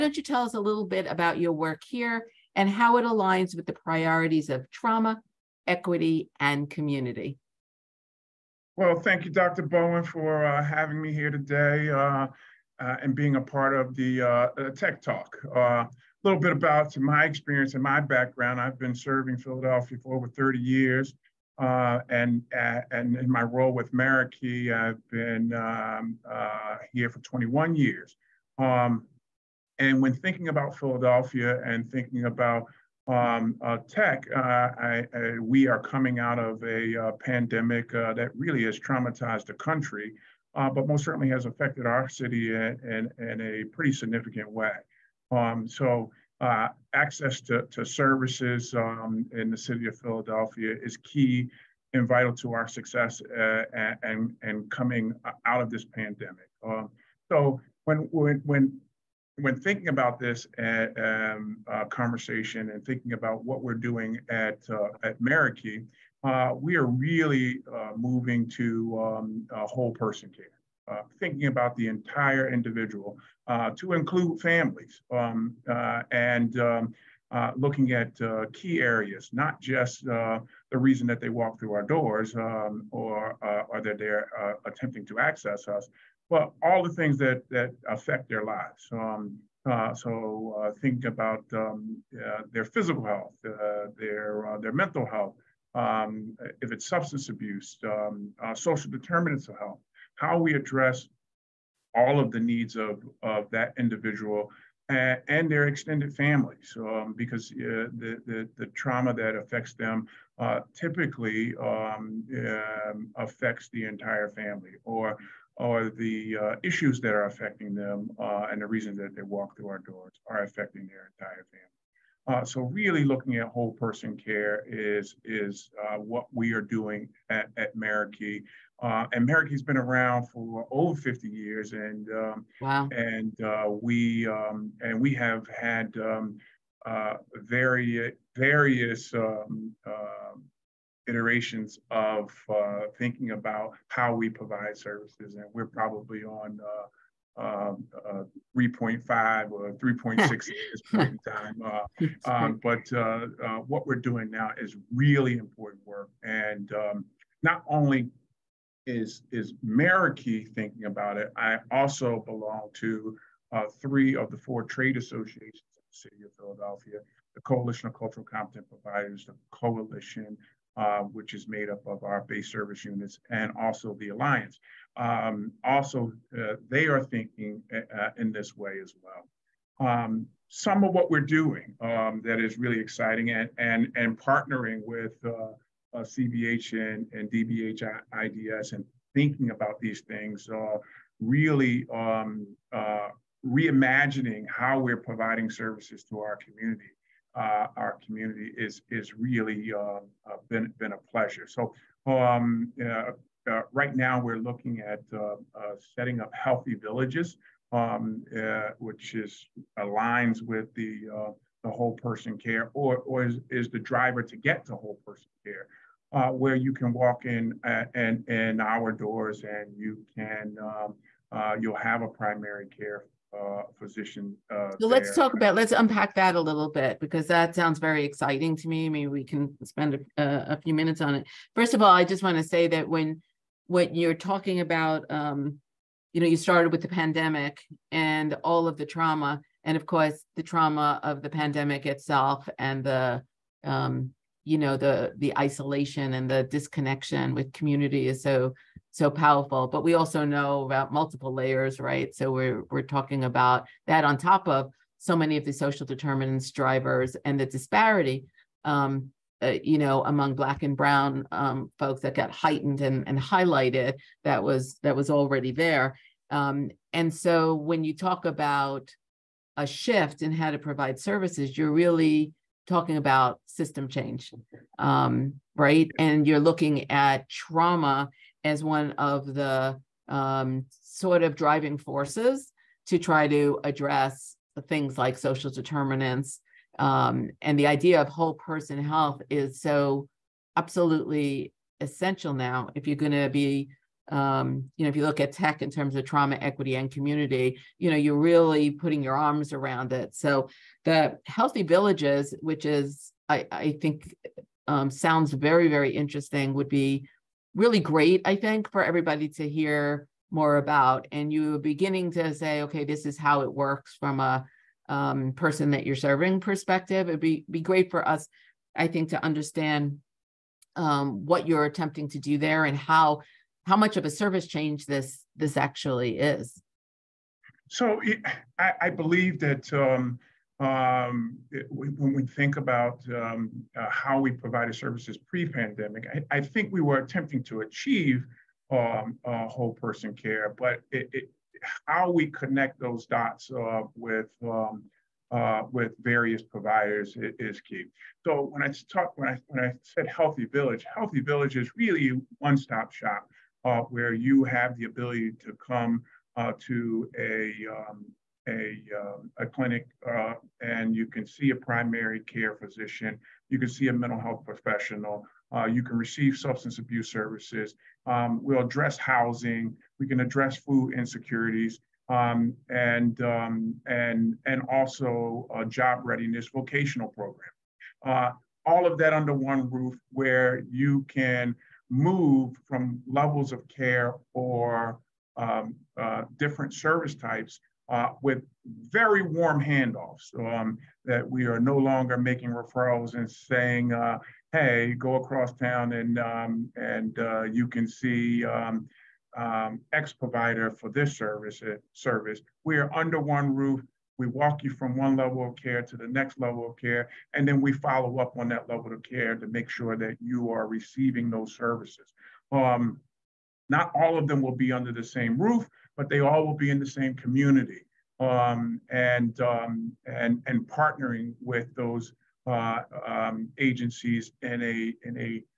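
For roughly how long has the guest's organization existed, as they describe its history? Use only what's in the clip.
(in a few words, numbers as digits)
over 50 years.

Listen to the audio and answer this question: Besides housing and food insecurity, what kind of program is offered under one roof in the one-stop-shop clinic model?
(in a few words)
job readiness vocational program.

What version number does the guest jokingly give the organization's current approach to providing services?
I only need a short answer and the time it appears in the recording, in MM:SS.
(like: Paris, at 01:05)
3.5 or 3.6, at 02:28.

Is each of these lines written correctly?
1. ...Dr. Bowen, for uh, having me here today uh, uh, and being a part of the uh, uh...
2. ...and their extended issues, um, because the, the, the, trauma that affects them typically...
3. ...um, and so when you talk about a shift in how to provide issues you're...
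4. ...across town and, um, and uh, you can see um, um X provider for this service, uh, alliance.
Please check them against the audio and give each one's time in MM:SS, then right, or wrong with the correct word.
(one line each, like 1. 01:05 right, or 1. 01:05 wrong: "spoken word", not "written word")
1. 00:09 right
2. 01:45 wrong: "families", not "issues"
3. 04:26 wrong: "services", not "issues"
4. 06:35 wrong: "service", not "alliance".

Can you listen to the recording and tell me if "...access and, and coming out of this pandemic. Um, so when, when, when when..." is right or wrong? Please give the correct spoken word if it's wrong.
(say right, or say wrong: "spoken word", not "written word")
wrong: "success", not "access".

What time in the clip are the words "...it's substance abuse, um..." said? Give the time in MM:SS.
01:36.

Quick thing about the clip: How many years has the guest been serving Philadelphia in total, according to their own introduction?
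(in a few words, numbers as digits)
over 30 years.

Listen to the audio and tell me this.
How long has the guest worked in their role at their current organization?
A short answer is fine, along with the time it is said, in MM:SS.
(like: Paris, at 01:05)
21 years, at 00:27.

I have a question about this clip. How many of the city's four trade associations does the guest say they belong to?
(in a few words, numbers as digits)
3.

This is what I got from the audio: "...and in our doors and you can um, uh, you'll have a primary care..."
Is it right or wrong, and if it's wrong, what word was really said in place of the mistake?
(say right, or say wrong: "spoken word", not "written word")
right.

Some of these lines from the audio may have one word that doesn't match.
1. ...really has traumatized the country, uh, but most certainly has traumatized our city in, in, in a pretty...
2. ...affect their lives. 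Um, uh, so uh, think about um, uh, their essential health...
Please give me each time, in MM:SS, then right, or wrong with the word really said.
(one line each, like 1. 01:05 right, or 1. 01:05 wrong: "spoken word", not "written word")
1. 00:38 wrong: "affected", not "traumatized"
2. 01:27 wrong: "physical", not "essential".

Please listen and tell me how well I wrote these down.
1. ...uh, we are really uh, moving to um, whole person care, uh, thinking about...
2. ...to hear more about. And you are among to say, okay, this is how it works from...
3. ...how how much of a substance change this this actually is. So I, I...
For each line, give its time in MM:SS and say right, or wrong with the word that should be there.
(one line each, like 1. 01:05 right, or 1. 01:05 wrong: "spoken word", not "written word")
1. 01:06 right
2. 05:09 wrong: "beginning", not "among"
3. 05:22 wrong: "service", not "substance".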